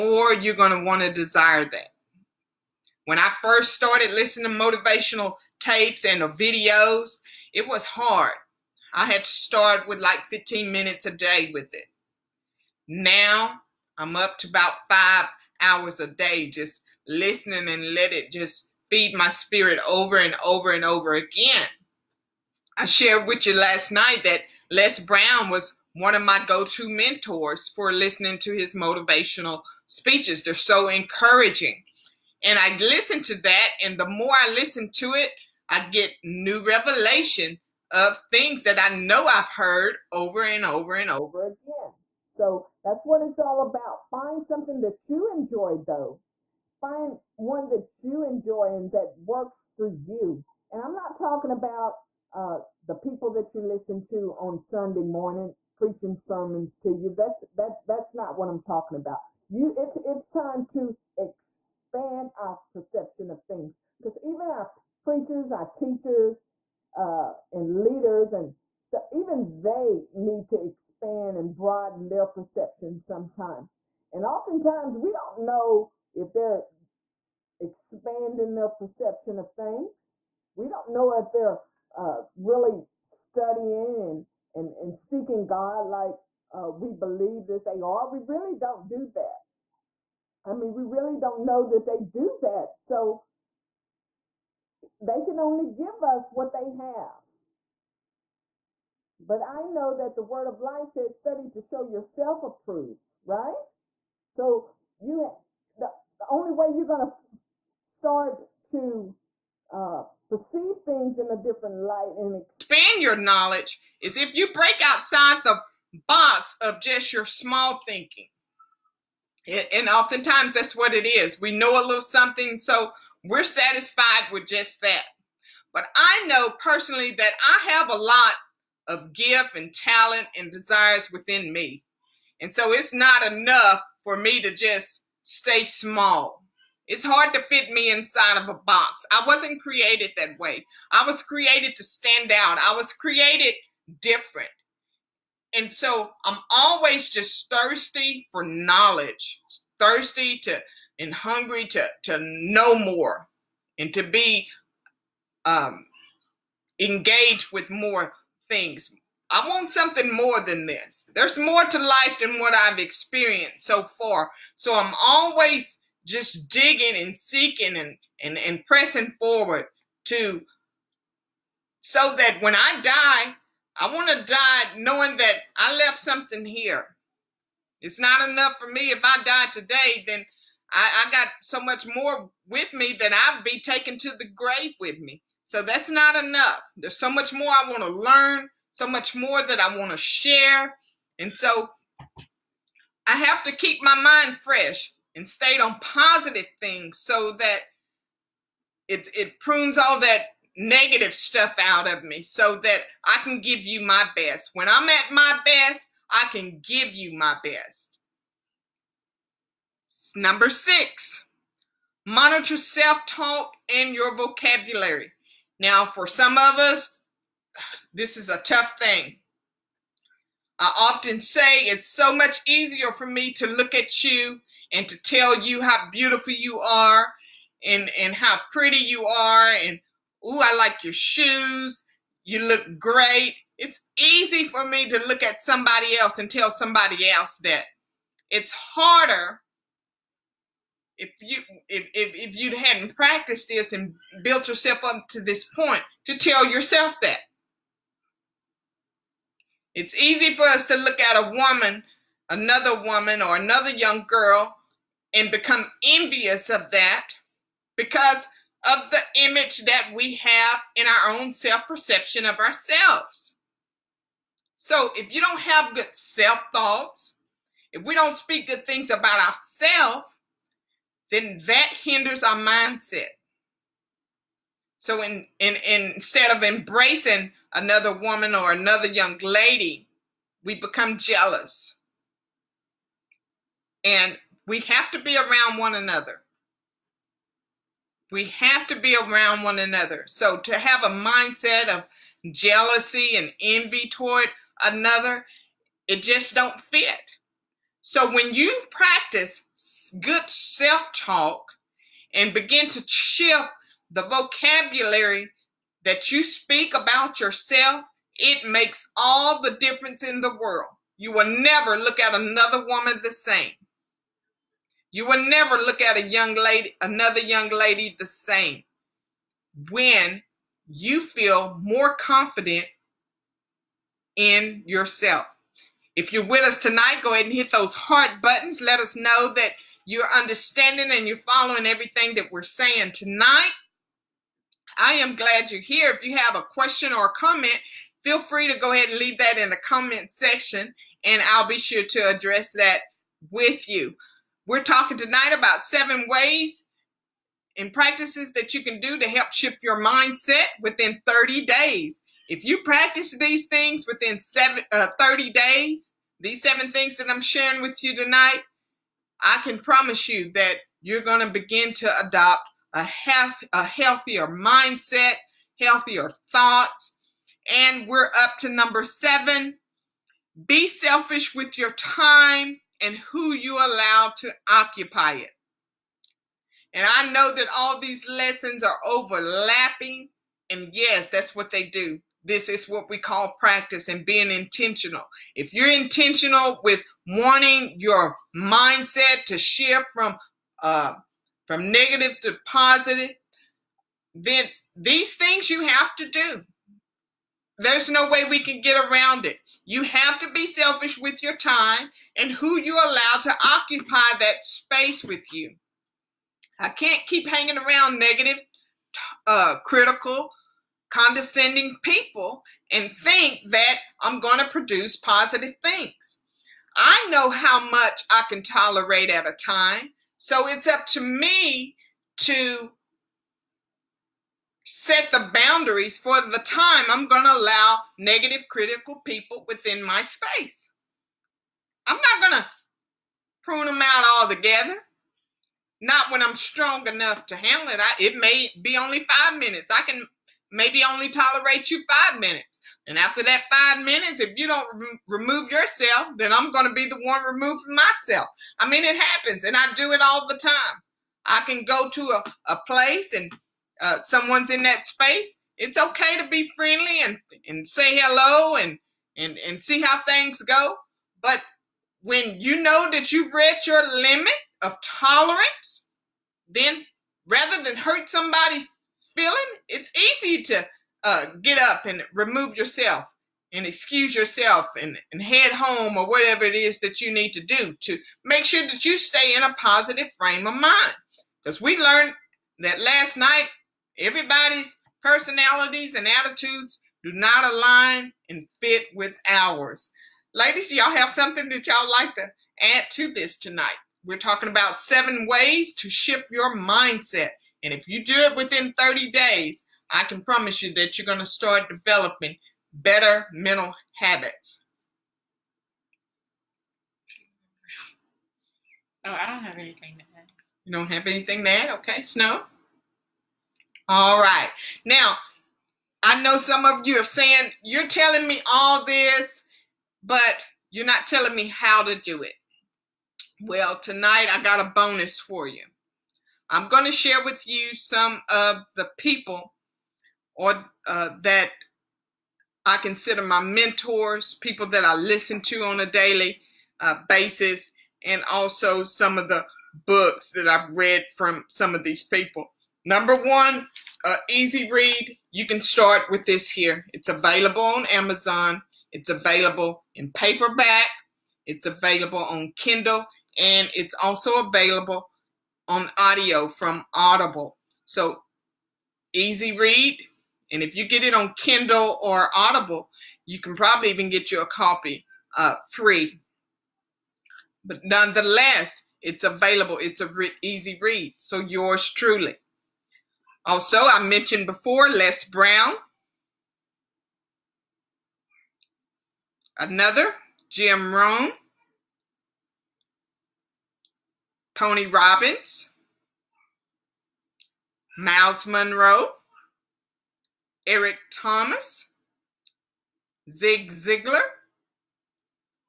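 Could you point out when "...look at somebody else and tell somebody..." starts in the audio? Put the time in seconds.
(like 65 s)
235 s.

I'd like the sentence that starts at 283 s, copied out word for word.
And we have to be around one another.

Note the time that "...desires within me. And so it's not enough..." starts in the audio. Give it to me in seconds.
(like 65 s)
130 s.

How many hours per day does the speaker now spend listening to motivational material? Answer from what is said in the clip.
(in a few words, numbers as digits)
5 hours.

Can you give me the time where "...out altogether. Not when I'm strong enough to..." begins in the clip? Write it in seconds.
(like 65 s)
433 s.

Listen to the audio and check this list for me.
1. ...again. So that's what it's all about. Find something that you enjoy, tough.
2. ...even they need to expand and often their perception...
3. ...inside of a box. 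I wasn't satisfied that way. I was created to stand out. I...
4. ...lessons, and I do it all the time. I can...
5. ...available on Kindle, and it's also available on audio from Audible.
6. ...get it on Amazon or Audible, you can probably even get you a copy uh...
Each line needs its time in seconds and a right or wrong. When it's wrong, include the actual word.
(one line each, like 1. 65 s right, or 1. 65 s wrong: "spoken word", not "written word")
1. 41 s wrong: "though", not "tough"
2. 69 s wrong: "broaden", not "often"
3. 137 s wrong: "created", not "satisfied"
4. 448 s wrong: "happens", not "lessons"
5. 551 s right
6. 560 s wrong: "Kindle", not "Amazon".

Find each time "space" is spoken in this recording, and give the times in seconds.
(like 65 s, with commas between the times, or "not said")
404 s, 430 s, 454 s.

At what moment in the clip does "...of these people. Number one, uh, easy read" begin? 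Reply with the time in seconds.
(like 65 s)
541 s.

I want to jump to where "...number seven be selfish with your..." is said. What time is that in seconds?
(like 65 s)
368 s.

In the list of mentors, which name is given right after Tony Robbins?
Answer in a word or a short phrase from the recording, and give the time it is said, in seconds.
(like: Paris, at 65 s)
Myles Munroe, at 587 s.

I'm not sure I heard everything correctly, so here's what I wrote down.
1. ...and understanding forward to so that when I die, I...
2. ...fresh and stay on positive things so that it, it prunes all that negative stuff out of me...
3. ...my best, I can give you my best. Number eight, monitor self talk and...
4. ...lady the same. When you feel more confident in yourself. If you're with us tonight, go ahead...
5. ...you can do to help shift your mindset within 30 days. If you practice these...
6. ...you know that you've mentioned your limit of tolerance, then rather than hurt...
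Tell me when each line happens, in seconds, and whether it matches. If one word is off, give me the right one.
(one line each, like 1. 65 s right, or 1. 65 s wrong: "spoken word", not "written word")
1. 168 s wrong: "pressing", not "understanding"
2. 194 s right
3. 205 s wrong: "six", not "eight"
4. 317 s right
5. 348 s right
6. 462 s wrong: "reached", not "mentioned".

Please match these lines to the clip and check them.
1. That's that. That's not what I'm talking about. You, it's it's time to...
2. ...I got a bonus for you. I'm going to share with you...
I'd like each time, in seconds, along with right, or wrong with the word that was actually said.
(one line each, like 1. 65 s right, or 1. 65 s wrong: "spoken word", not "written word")
1. 57 s right
2. 524 s right.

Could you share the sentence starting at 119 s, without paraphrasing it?
and oftentimes that's what it is.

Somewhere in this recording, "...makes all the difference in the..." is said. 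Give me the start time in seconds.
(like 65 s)
308 s.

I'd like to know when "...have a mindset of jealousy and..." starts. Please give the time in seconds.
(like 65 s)
290 s.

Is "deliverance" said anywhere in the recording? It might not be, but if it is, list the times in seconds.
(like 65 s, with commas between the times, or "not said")
not said.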